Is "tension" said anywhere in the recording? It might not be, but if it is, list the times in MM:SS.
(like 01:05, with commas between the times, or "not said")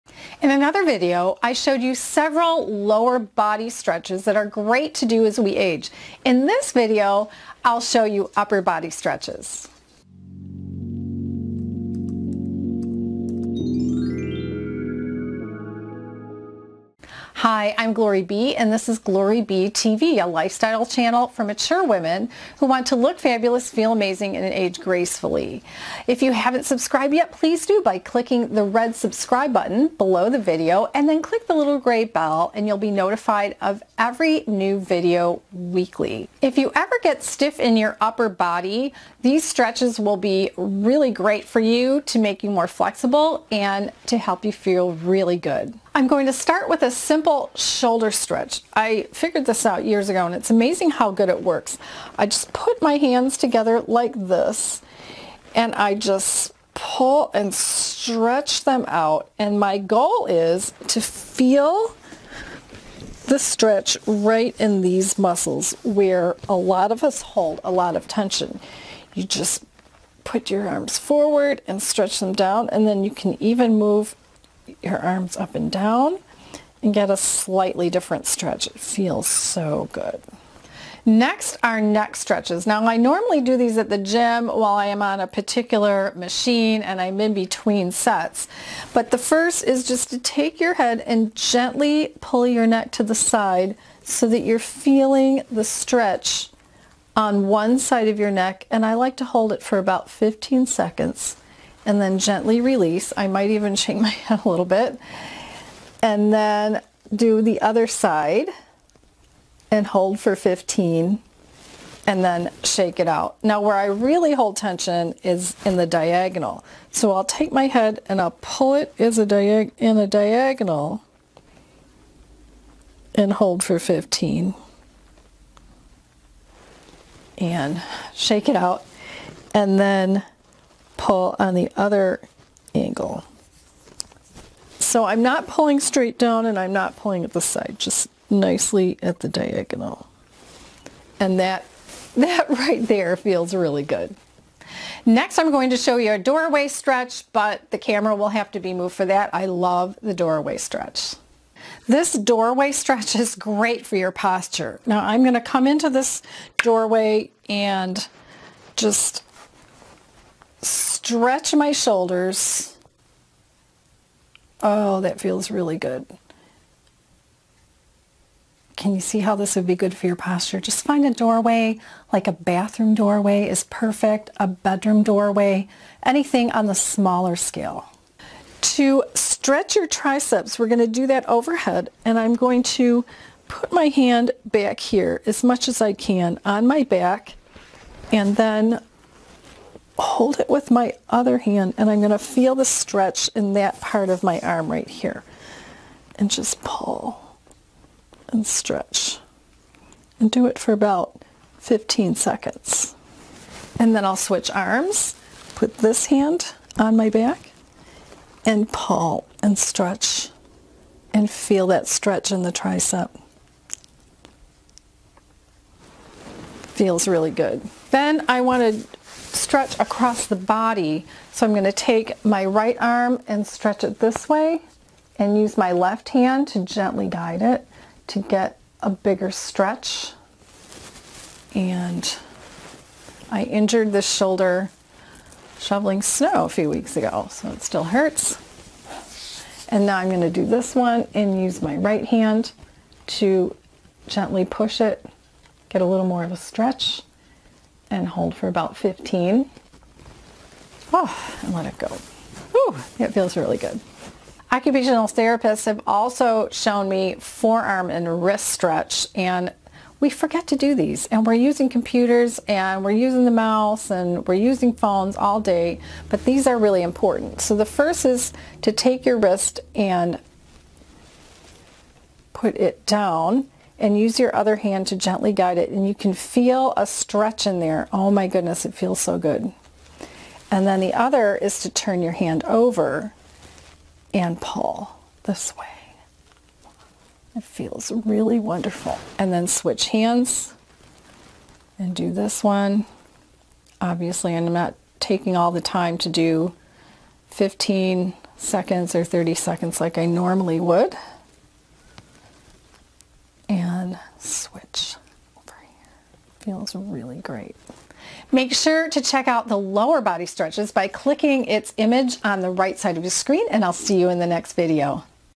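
01:08, 01:54.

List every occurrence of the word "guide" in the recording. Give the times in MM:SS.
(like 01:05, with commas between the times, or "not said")
03:47, 04:35.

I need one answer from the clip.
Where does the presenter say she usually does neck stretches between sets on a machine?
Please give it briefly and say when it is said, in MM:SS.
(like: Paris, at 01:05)
At the gym, at 01:23.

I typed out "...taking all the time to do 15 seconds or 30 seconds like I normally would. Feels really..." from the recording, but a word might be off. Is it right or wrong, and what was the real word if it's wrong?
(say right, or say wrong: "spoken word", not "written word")
right.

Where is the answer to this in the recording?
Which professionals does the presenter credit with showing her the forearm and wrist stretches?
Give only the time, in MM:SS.
04:14.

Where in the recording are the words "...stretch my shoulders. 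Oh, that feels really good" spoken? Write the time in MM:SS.
02:40.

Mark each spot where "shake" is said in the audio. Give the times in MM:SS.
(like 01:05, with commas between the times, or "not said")
01:43, 01:52, 02:08.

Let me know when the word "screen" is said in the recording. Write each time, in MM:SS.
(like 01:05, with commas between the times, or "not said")
05:13.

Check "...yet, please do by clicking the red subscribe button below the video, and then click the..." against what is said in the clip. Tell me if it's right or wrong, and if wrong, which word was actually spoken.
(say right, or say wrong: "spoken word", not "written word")
right.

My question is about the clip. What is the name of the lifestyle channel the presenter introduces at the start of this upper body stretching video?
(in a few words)
Glory B TV.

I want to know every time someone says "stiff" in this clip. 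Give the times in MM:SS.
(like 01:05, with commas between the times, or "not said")
00:37.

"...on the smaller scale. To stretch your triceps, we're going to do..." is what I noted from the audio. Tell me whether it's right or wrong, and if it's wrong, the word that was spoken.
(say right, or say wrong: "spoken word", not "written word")
right.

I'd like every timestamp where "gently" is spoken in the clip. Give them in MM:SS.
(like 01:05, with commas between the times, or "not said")
01:31, 01:42, 03:46, 04:04, 04:34.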